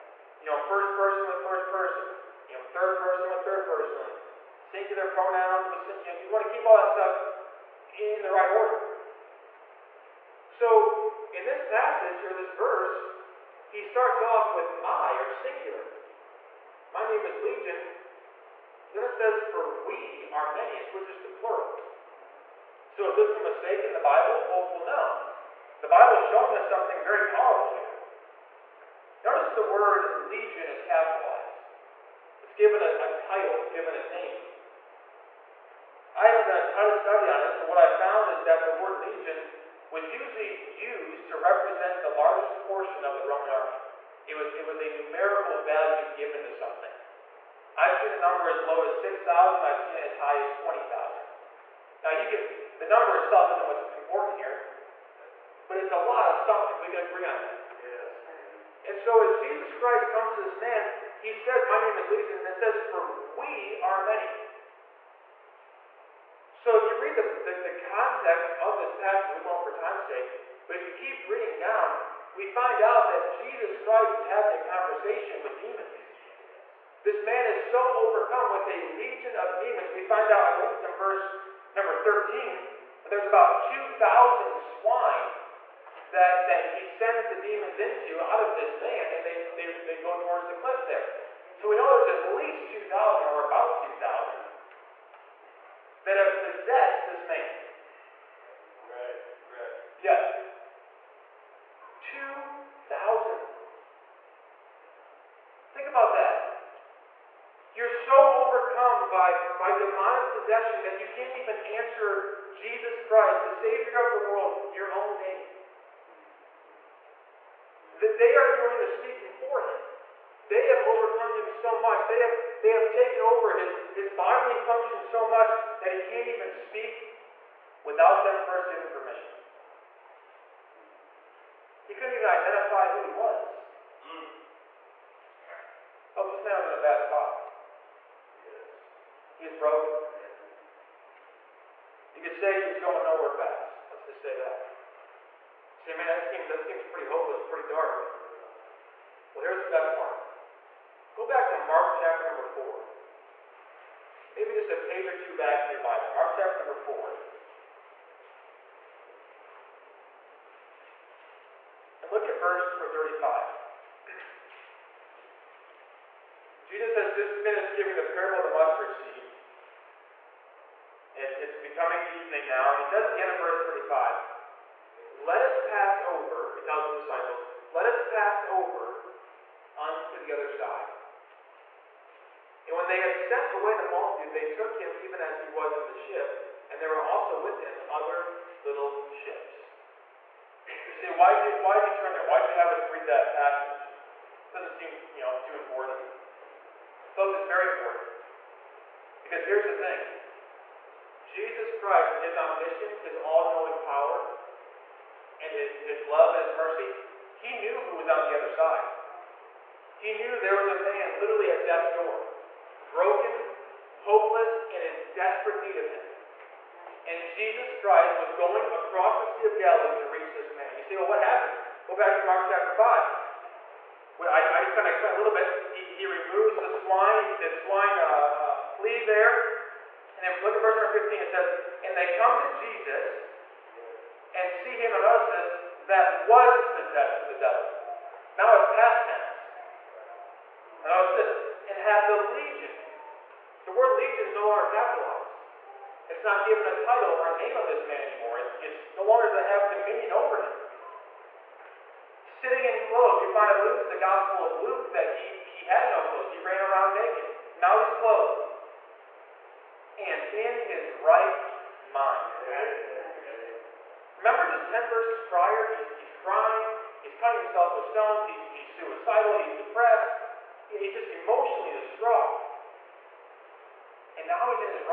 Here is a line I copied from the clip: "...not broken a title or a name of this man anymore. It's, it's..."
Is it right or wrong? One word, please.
wrong.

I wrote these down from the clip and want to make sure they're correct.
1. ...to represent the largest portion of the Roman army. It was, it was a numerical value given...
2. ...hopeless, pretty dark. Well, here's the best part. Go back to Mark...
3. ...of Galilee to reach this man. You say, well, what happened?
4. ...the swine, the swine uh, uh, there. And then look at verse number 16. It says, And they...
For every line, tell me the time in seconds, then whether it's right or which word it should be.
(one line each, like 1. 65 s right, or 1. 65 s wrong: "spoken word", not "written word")
1. 41 s right
2. 147 s right
3. 219 s right
4. 226 s wrong: "15", not "16".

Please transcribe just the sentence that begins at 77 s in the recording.
This man is so overcome with a legion of demons.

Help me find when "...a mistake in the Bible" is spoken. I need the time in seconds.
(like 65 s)
23 s.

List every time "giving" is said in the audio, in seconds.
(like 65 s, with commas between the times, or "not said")
128 s, 167 s.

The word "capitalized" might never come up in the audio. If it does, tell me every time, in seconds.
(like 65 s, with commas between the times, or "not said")
30 s, 244 s.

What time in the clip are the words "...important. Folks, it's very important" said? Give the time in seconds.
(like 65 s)
195 s.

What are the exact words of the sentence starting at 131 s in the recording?
He couldn't even identify who he was.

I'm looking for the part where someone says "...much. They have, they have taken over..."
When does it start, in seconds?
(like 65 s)
121 s.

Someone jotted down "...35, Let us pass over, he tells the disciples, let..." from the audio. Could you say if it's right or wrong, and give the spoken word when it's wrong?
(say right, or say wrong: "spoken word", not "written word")
right.